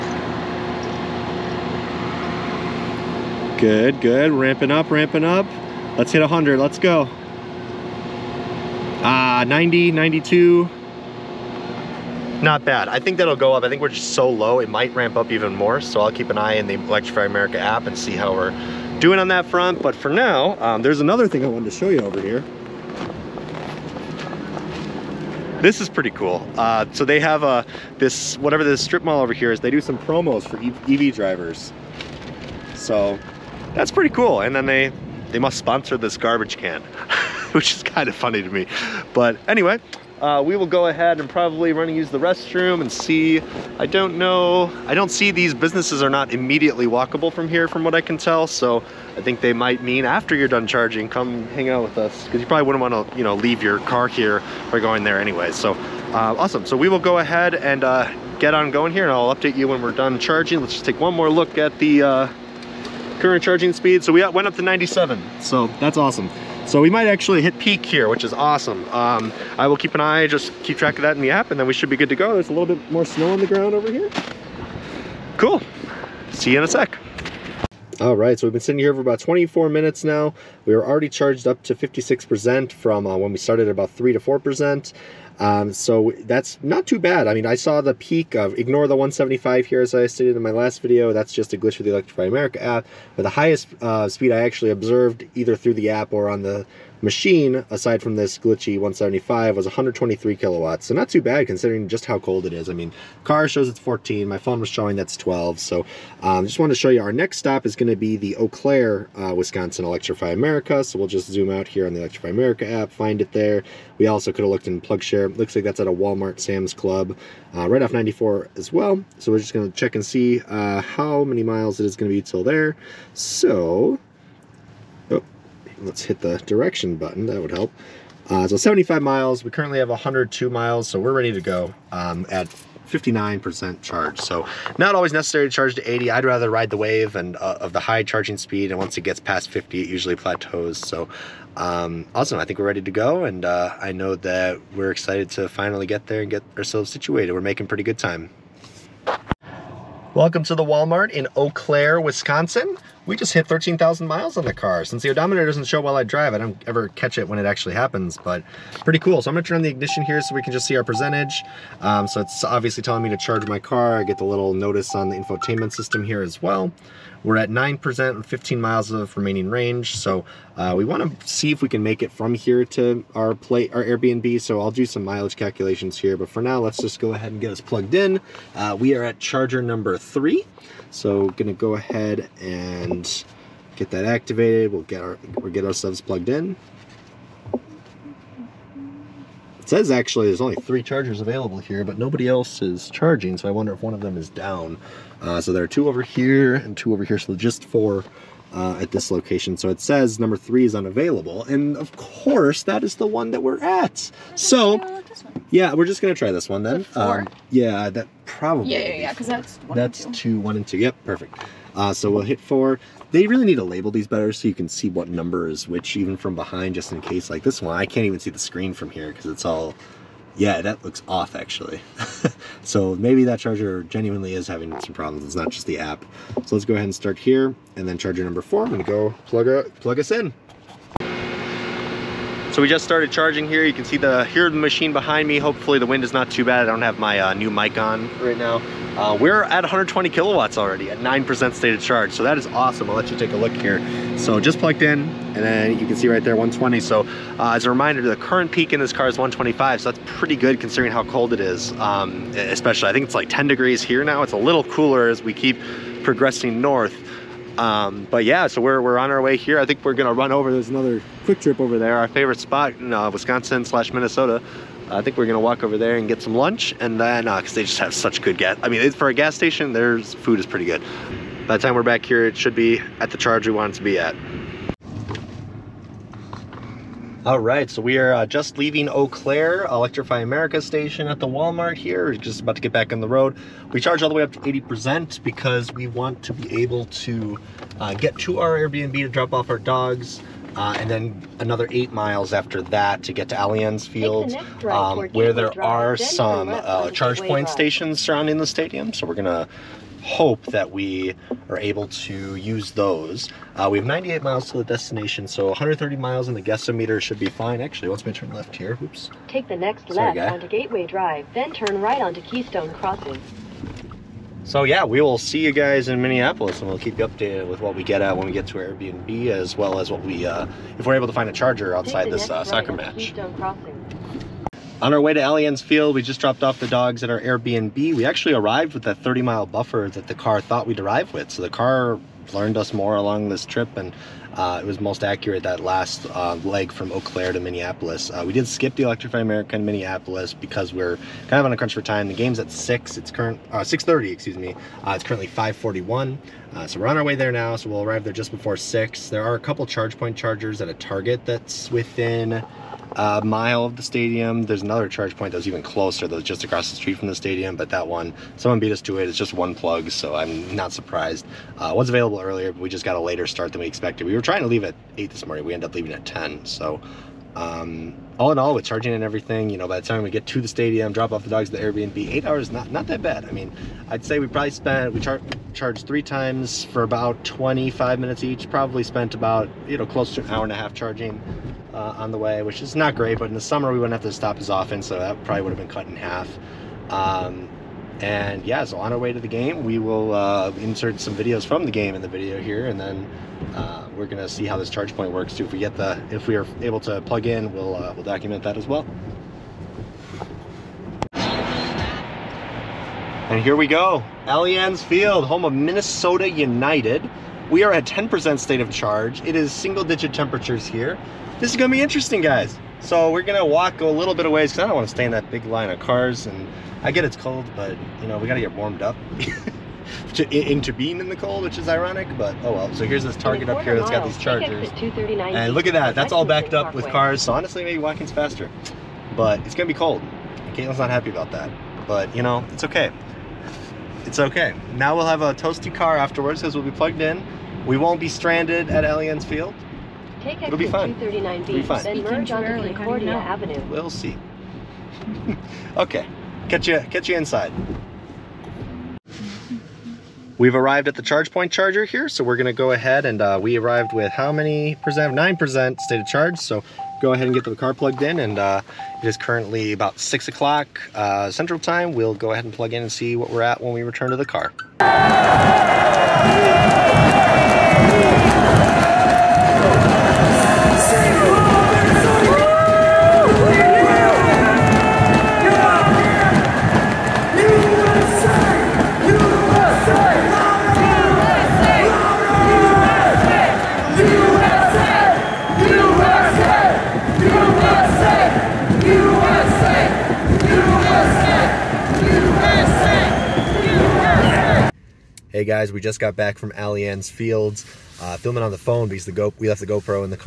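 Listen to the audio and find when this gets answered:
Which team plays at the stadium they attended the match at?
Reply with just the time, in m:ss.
6:45.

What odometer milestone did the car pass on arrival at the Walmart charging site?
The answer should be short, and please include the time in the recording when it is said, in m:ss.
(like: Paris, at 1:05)
13,000 miles, at 2:33.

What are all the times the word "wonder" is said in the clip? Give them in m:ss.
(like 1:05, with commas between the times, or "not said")
3:13.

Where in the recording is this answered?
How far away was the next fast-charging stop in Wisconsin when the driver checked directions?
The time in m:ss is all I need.
2:08.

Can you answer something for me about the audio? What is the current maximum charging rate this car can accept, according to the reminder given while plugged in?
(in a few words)
125.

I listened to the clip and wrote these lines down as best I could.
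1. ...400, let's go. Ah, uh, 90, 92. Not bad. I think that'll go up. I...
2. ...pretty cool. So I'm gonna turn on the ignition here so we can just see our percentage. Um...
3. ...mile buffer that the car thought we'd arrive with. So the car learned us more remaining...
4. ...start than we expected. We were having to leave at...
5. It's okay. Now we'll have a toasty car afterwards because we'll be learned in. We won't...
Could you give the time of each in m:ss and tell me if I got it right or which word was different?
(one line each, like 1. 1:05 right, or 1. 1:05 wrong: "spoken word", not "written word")
1. 0:06 wrong: "100", not "400"
2. 2:38 right
3. 5:29 wrong: "along", not "remaining"
4. 6:03 wrong: "trying", not "having"
5. 7:14 wrong: "plugged", not "learned".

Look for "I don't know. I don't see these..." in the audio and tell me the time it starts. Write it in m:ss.
0:43.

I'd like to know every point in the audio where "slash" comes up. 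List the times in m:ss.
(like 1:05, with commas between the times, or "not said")
4:23.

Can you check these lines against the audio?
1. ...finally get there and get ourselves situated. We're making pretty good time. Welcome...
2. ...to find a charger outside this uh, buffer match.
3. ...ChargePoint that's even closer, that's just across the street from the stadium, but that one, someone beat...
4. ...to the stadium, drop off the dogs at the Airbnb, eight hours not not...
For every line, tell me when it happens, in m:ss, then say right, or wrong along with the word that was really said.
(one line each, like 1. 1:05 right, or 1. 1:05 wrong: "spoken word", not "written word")
1. 2:25 right
2. 5:21 wrong: "soccer", not "buffer"
3. 5:54 right
4. 6:10 right.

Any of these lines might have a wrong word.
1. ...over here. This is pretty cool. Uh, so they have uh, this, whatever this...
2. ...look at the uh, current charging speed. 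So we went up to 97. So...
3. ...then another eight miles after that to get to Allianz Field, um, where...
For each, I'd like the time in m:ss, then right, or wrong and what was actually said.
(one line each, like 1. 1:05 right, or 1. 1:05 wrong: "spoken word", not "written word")
1. 0:21 right
2. 1:01 right
3. 4:50 right.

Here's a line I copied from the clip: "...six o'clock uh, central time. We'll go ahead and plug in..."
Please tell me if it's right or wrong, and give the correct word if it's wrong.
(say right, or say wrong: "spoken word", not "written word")
right.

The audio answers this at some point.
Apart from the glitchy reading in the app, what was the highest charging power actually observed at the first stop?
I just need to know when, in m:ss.
1:39.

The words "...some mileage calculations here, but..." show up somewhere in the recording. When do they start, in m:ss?
2:54.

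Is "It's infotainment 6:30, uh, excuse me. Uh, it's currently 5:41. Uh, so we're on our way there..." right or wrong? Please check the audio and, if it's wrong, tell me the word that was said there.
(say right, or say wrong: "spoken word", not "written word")
wrong: "current", not "infotainment".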